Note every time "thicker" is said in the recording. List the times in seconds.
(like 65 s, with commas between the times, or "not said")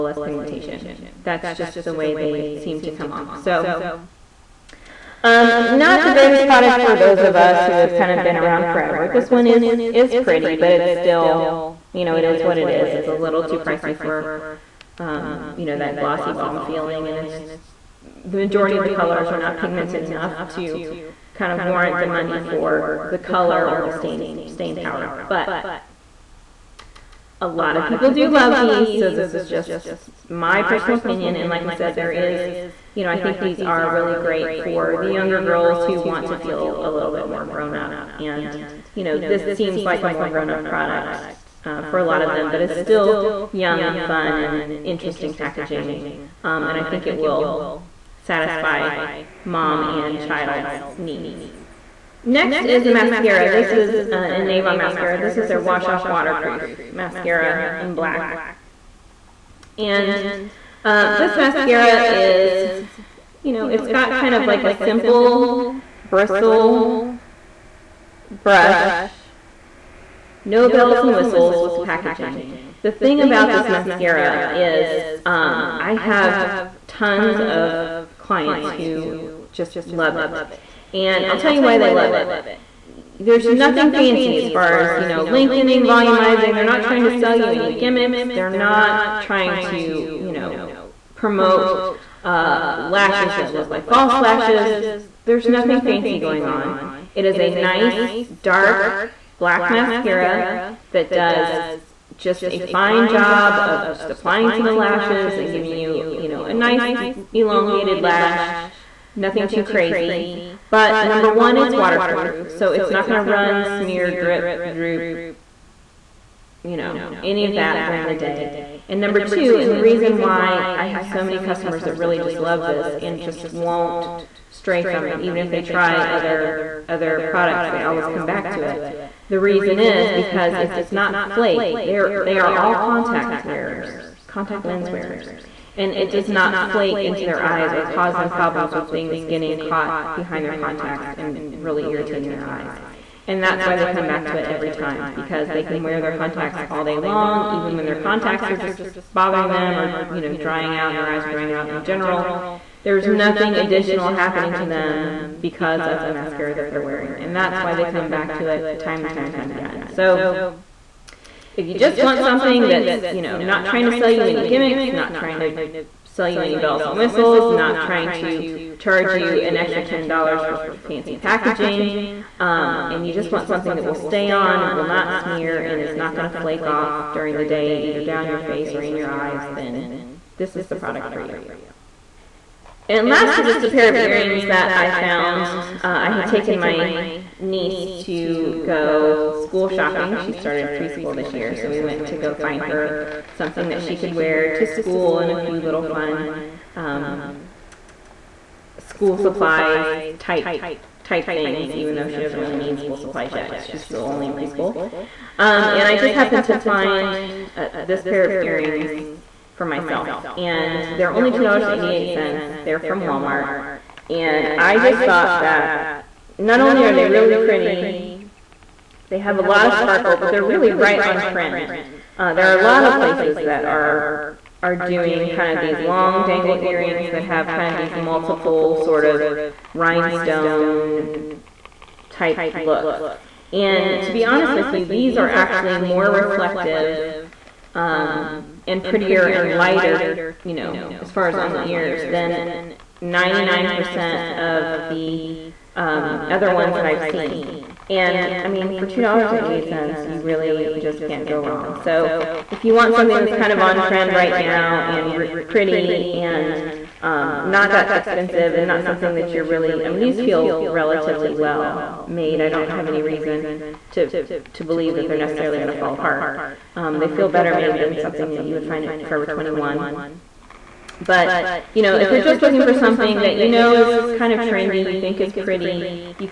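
not said.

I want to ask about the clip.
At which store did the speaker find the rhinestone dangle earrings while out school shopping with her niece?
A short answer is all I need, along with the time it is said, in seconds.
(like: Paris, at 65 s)
Walmart, at 213 s.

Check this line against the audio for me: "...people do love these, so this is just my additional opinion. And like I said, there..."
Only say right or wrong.
wrong.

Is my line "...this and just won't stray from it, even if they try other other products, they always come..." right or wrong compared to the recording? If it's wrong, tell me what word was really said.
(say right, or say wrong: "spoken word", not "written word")
right.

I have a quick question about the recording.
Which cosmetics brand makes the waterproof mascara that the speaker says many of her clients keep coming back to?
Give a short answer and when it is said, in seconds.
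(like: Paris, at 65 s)
Avon, at 54 s.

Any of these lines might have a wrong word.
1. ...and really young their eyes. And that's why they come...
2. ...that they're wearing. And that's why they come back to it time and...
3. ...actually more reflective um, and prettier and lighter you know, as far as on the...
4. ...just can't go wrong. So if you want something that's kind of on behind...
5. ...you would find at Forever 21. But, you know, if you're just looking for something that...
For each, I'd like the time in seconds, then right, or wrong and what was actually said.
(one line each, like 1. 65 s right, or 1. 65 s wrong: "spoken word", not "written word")
1. 141 s wrong: "irritating", not "young"
2. 156 s right
3. 235 s right
4. 250 s wrong: "trend", not "behind"
5. 268 s right.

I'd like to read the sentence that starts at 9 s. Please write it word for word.
This one is, is pretty, but it's still, you know, it is what it is.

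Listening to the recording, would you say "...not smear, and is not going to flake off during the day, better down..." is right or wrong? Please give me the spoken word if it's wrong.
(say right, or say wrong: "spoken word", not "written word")
wrong: "either", not "better".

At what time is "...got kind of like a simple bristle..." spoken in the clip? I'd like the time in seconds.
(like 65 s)
63 s.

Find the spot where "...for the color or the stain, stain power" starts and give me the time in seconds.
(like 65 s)
22 s.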